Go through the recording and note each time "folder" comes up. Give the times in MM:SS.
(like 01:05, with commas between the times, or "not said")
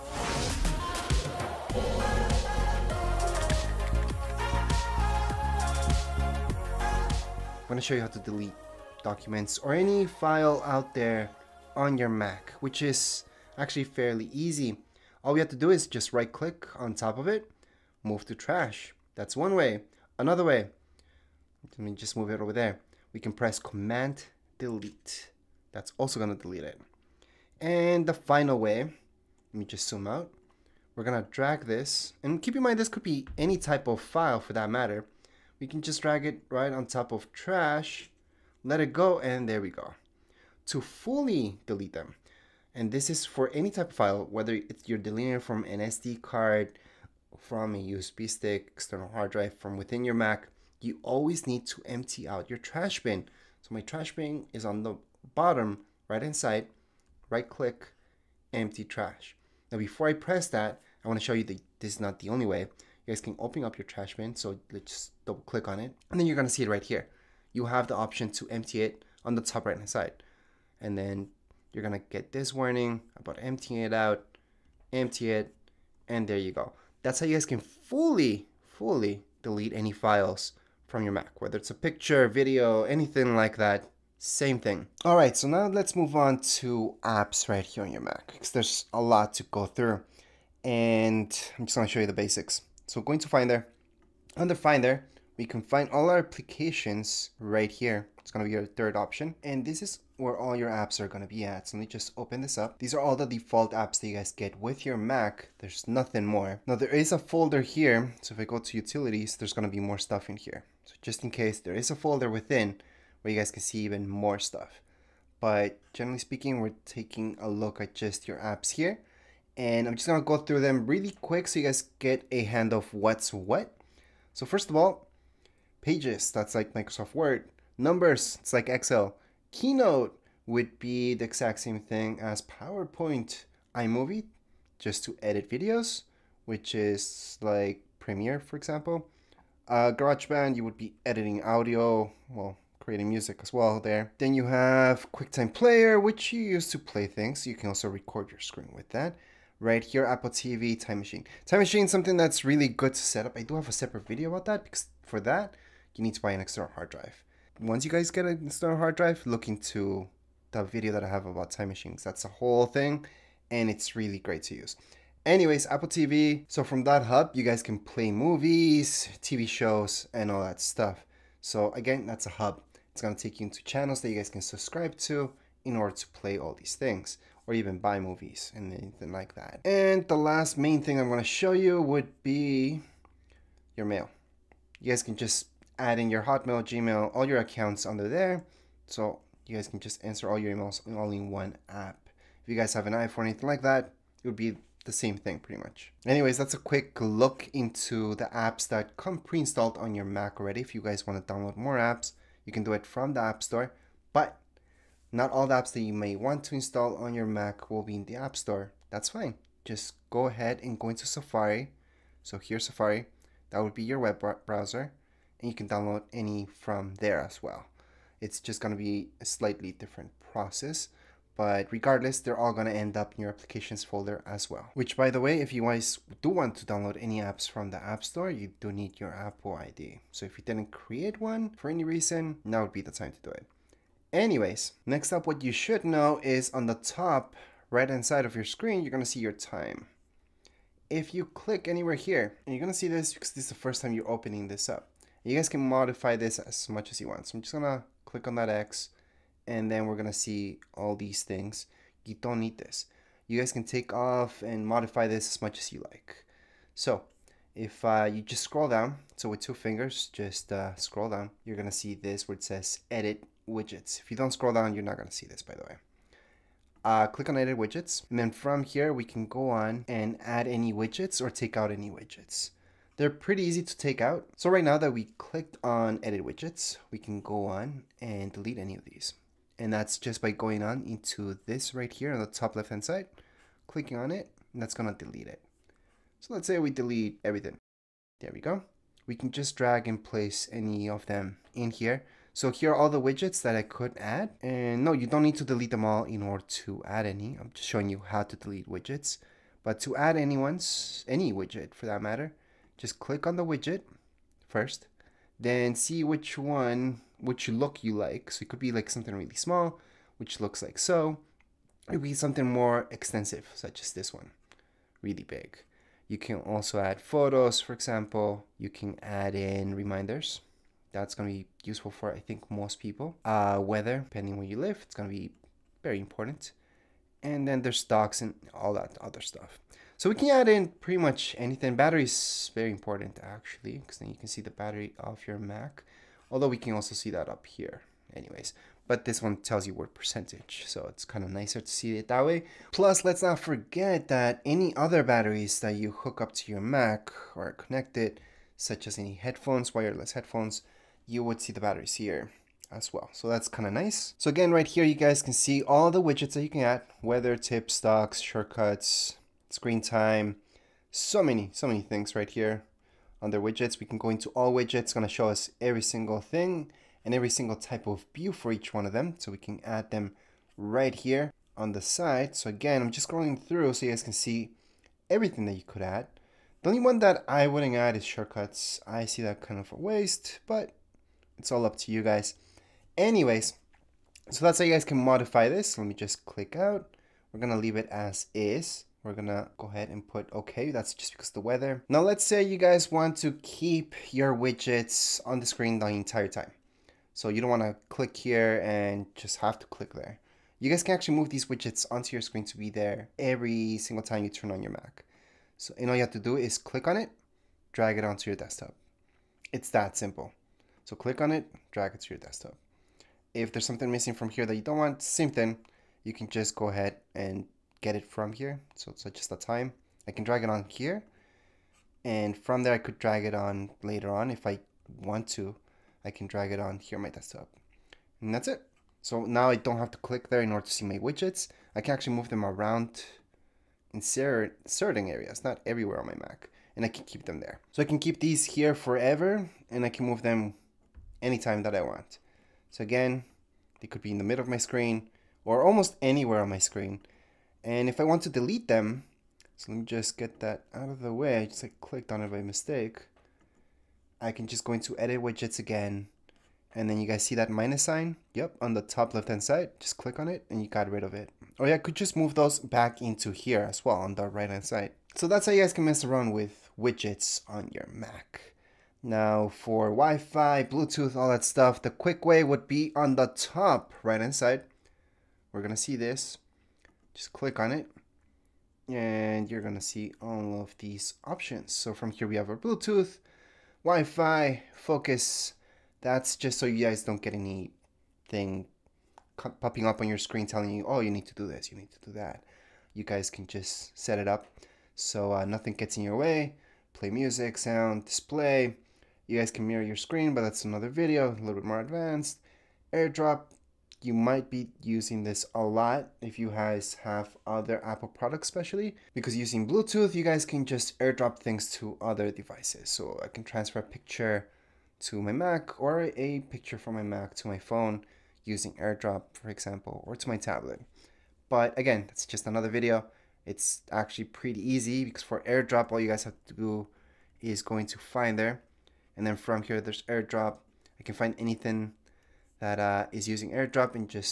01:47, 01:51, 03:43.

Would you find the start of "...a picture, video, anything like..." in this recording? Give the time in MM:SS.
01:21.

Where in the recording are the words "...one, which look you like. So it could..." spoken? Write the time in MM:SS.
05:06.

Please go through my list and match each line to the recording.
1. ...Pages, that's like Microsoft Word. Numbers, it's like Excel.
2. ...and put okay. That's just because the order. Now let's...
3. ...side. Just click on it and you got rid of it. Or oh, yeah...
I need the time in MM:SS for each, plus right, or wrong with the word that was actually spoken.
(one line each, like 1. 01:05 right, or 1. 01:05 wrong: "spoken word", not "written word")
1. 02:05 right
2. 06:29 wrong: "weather", not "order"
3. 07:39 right.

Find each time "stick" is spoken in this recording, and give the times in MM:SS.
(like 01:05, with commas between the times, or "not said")
00:48.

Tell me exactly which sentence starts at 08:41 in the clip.
But again, that's just another video.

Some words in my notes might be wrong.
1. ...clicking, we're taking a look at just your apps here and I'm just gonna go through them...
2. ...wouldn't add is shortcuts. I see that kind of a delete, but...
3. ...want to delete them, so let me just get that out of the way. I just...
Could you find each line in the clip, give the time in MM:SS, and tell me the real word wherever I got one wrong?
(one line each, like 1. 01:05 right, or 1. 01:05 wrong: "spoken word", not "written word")
1. 01:56 wrong: "speaking", not "clicking"
2. 06:17 wrong: "waste", not "delete"
3. 07:28 right.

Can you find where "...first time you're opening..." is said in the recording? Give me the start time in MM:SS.
04:03.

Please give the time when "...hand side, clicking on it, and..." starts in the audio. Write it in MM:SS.
04:42.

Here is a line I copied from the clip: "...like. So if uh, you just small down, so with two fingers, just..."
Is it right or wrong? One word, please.
wrong.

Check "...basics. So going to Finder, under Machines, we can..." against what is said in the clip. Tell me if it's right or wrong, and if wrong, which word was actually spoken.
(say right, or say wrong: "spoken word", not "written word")
wrong: "Finder", not "Machines".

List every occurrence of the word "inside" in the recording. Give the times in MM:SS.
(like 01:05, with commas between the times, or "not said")
00:56, 07:54.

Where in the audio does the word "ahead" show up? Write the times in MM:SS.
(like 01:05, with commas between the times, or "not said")
03:30, 06:29, 06:56.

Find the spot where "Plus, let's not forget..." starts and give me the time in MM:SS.
05:42.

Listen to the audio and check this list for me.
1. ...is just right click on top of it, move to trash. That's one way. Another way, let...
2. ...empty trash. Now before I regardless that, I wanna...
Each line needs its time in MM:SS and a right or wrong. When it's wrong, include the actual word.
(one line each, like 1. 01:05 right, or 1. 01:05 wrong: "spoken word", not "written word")
1. 00:15 right
2. 00:58 wrong: "press", not "regardless".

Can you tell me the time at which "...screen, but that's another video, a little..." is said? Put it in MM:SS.
08:19.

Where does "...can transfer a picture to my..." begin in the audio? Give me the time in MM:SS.
08:33.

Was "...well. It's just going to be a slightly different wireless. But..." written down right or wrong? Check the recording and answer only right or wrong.
wrong.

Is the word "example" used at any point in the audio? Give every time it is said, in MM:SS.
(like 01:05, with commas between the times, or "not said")
02:18, 05:17, 08:39.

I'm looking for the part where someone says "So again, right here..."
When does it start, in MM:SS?
05:54.